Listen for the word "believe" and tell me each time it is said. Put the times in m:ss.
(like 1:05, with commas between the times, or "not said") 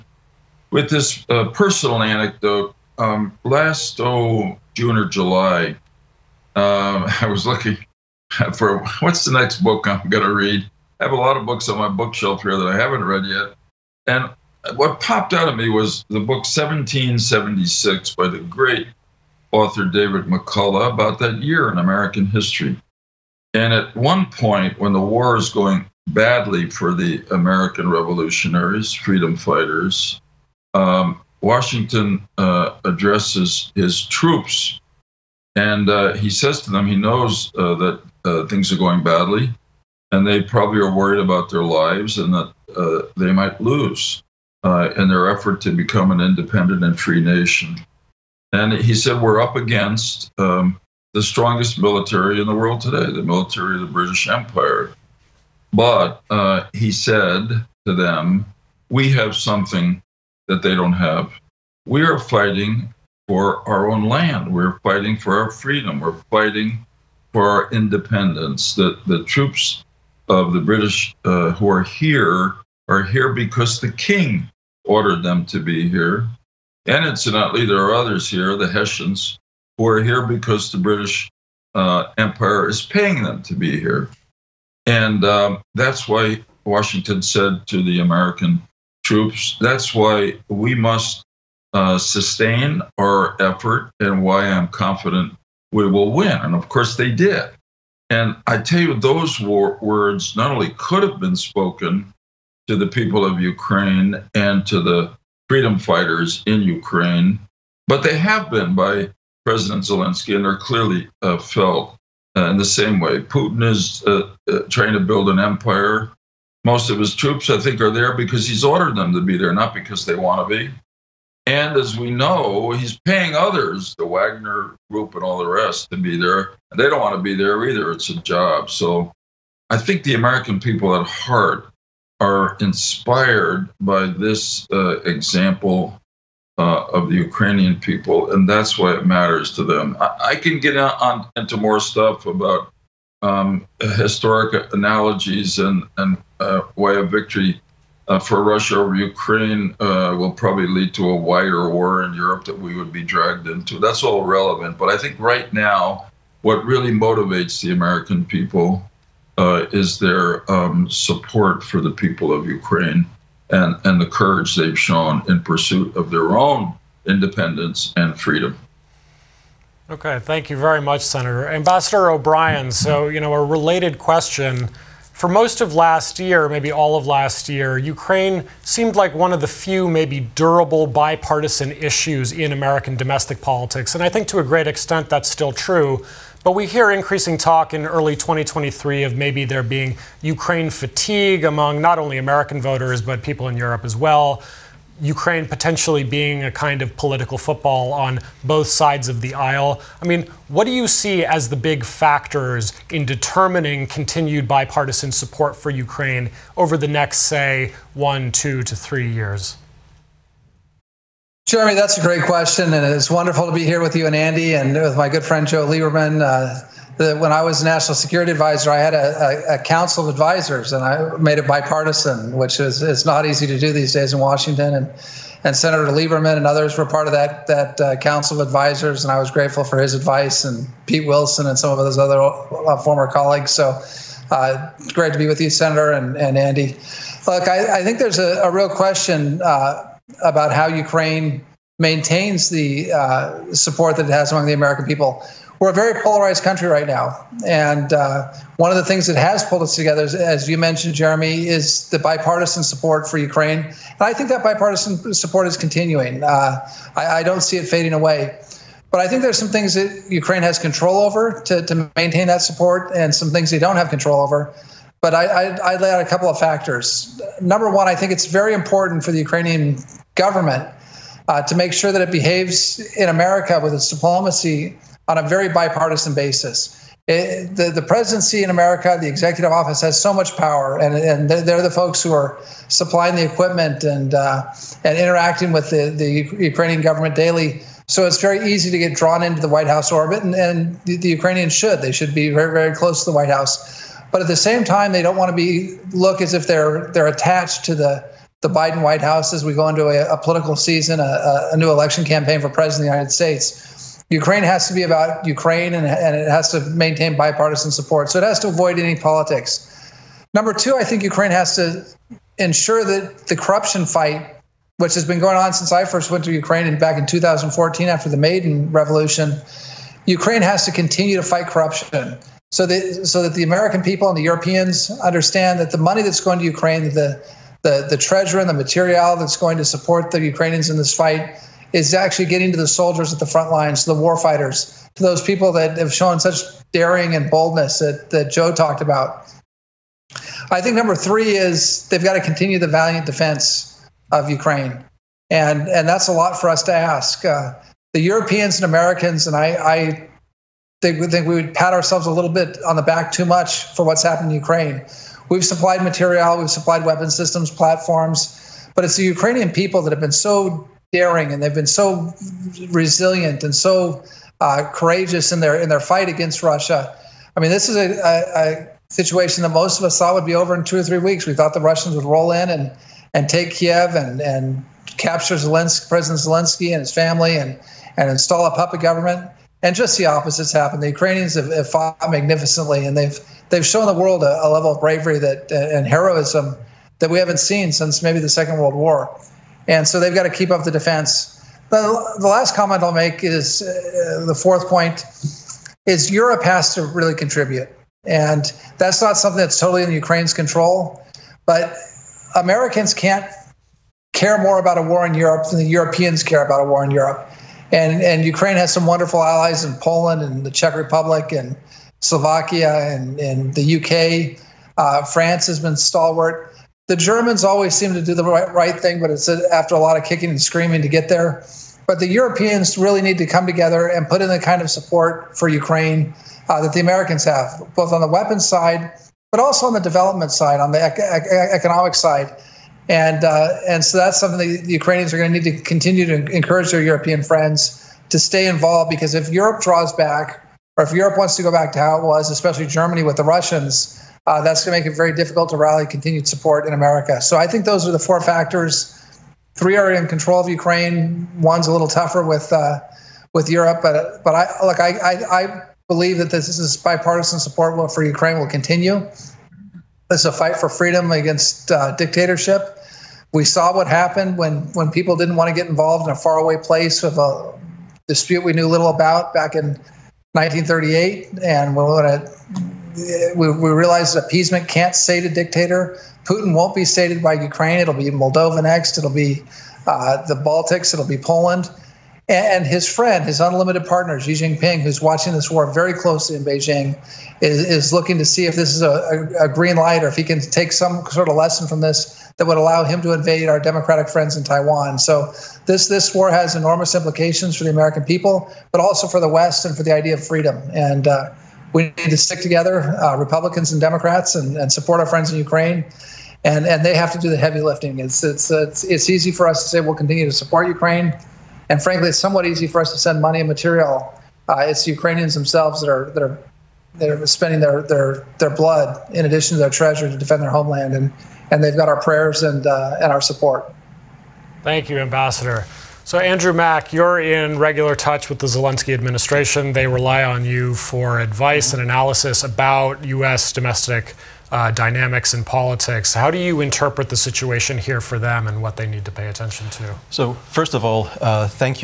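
7:35.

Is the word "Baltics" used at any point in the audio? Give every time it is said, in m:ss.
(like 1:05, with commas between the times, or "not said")
8:00.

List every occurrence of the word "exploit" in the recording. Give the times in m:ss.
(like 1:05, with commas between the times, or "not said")
not said.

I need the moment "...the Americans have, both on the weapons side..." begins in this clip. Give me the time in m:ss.
7:06.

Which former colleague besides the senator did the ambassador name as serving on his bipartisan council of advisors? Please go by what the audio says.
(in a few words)
Pete Wilson.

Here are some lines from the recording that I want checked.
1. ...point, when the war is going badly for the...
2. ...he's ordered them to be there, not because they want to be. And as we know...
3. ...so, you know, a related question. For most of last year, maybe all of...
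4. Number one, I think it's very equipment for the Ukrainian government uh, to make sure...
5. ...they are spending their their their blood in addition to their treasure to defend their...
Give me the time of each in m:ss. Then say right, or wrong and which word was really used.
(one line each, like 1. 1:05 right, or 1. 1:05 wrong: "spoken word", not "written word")
1. 0:24 right
2. 1:58 right
3. 2:52 right
4. 4:27 wrong: "important", not "equipment"
5. 8:36 right.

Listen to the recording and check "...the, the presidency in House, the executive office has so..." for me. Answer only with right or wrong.
wrong.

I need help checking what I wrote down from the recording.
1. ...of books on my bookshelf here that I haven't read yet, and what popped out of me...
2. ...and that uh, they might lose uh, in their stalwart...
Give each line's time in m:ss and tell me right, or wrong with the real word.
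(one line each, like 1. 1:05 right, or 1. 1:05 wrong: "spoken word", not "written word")
1. 0:11 right
2. 0:42 wrong: "effort", not "stalwart".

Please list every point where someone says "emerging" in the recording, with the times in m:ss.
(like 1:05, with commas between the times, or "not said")
not said.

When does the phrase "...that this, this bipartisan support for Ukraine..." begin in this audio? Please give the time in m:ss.
7:36.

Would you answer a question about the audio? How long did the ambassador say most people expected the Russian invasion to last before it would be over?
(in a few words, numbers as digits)
two or three weeks.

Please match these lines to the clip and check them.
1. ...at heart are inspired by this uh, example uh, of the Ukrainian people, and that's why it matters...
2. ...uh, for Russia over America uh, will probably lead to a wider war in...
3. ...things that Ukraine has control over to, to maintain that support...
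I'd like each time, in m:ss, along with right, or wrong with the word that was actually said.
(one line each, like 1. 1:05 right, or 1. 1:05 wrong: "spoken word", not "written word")
1. 2:10 right
2. 2:28 wrong: "Ukraine", not "America"
3. 4:19 right.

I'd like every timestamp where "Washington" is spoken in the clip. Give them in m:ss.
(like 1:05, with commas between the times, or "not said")
0:31, 1:26, 3:44.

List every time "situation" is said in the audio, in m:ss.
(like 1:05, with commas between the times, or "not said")
6:08, 8:57.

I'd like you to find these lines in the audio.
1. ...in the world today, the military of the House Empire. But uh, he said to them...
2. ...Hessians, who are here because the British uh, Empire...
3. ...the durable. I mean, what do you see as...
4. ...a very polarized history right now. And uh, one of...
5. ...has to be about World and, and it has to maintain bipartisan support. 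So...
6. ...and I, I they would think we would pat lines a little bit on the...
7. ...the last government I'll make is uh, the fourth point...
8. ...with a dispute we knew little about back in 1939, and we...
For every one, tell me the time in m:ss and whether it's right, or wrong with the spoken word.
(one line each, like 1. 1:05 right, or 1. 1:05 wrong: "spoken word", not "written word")
1. 0:52 wrong: "British", not "House"
2. 1:18 right
3. 3:19 wrong: "aisle", not "durable"
4. 4:05 wrong: "country", not "history"
5. 5:04 wrong: "Ukraine", not "World"
6. 5:49 wrong: "ourselves", not "lines"
7. 6:32 wrong: "comment", not "government"
8. 7:47 wrong: "1938", not "1939".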